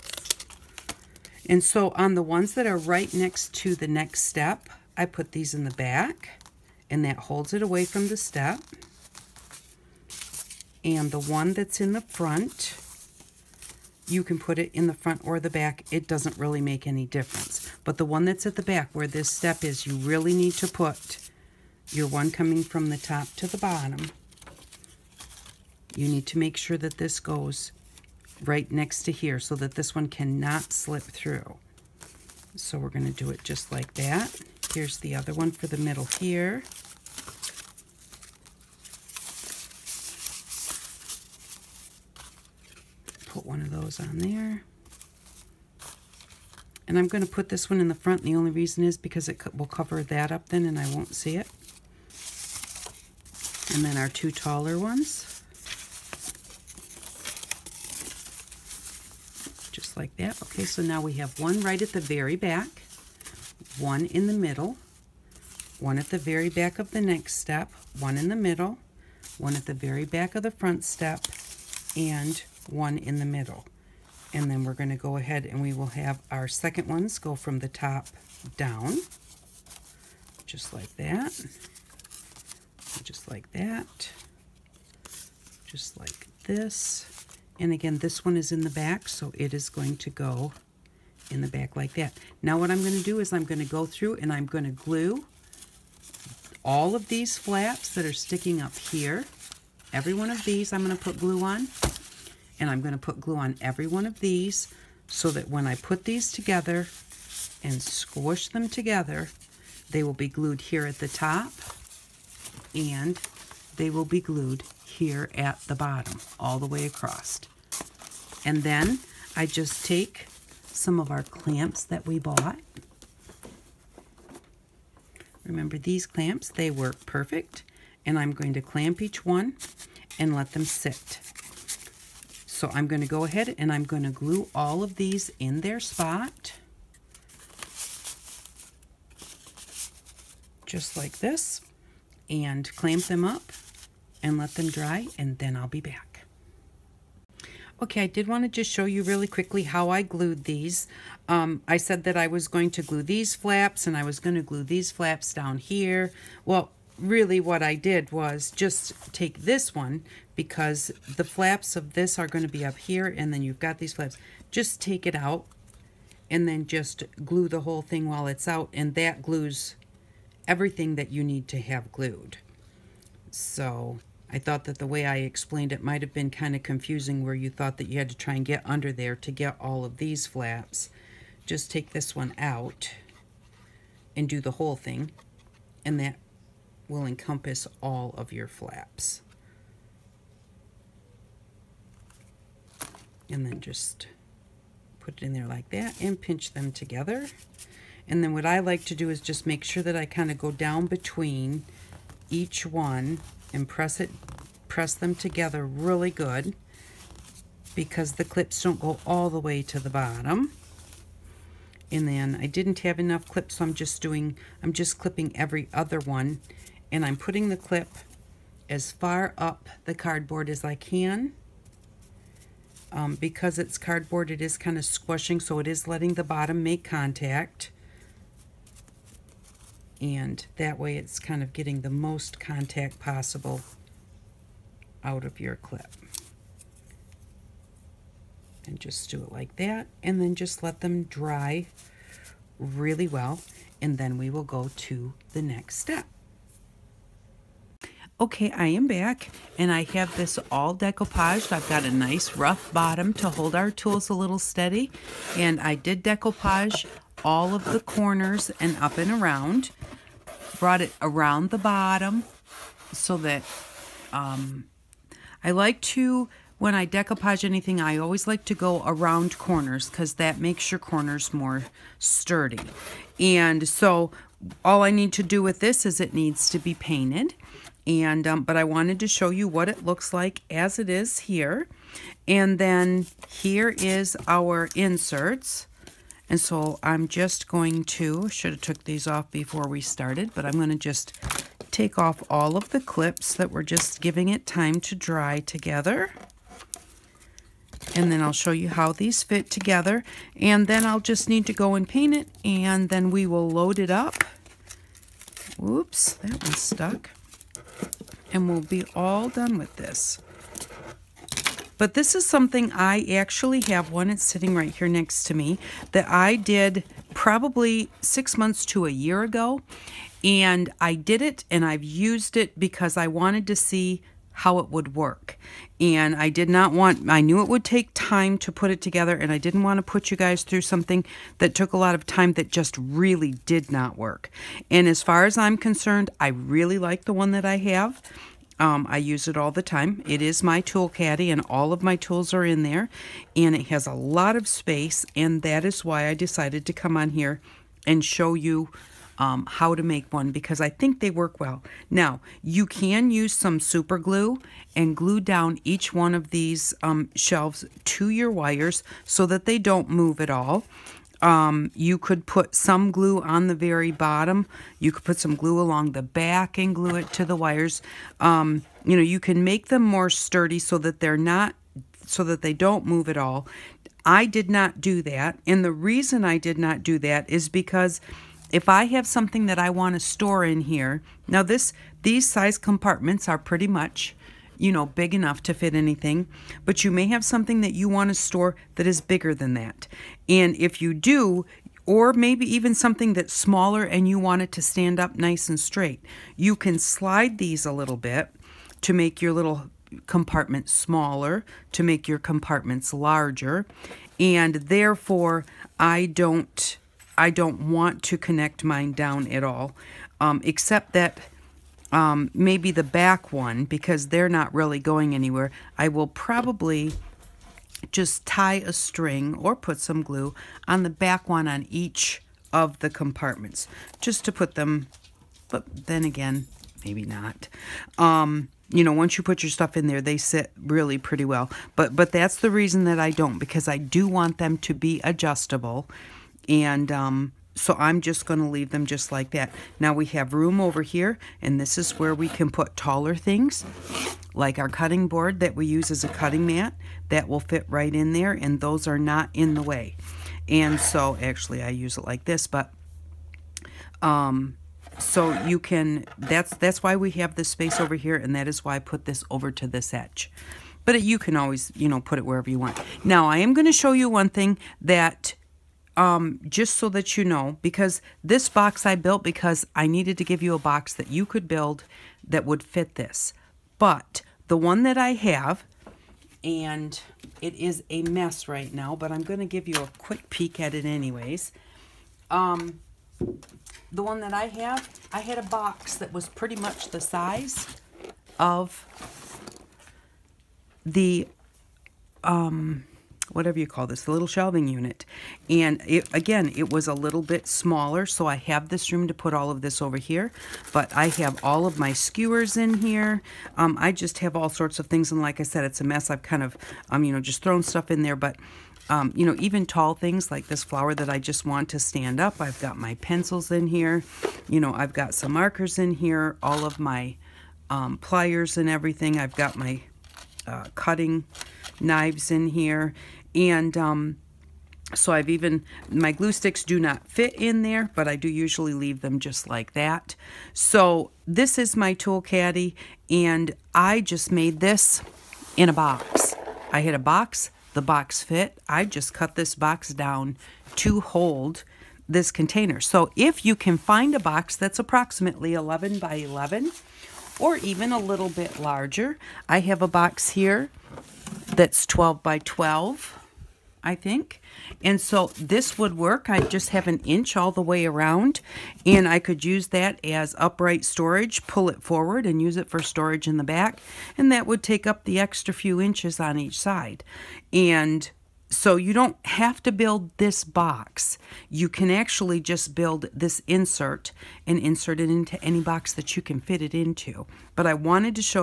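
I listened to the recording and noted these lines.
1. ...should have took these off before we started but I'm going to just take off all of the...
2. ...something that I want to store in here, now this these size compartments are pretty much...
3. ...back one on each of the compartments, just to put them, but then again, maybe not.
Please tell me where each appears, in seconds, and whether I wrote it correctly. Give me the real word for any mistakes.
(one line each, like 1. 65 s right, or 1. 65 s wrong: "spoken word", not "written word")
1. 288 s right
2. 379 s right
3. 420 s right.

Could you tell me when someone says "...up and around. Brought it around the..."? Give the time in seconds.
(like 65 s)
258 s.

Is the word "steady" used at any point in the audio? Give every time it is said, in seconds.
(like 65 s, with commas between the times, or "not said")
254 s.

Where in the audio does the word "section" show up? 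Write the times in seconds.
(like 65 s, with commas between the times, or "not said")
not said.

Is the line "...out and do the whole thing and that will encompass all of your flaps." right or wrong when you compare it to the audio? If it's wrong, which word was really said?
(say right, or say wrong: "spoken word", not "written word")
right.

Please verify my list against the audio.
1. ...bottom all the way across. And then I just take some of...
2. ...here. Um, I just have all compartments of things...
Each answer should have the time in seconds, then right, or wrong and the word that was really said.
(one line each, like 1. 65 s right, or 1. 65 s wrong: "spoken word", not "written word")
1. 115 s right
2. 502 s wrong: "sorts", not "compartments".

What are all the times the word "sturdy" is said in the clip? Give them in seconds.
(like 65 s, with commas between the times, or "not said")
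271 s, 370 s.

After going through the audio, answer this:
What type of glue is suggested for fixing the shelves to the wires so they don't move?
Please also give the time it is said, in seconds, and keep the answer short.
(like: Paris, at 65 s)
Super glue, at 353 s.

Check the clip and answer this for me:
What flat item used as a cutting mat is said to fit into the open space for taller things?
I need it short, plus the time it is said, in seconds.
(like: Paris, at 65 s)
Cutting board, at 444 s.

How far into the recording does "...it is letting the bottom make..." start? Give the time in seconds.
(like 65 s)
225 s.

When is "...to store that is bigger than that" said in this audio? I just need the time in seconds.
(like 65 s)
388 s.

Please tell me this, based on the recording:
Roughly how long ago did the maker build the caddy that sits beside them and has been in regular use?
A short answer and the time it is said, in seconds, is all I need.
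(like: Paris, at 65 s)
Six months to a year, at 318 s.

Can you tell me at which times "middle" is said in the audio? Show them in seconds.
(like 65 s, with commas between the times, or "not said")
35 s, 64 s, 68 s, 73 s.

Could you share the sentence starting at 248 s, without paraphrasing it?
Okay, I am back and I have this all decoupaged.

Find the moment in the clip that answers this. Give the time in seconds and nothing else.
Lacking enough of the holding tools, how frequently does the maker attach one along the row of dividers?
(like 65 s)
215 s.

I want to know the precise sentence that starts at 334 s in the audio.
And as far as I'm concerned, I really like the one that I have.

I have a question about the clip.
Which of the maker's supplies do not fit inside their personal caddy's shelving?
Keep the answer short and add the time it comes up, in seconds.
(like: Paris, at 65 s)
Glue sticks, at 526 s.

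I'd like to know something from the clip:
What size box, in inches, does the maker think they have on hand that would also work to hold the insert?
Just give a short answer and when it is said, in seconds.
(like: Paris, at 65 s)
12 by 12, at 551 s.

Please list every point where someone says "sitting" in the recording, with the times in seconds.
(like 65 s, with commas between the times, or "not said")
314 s.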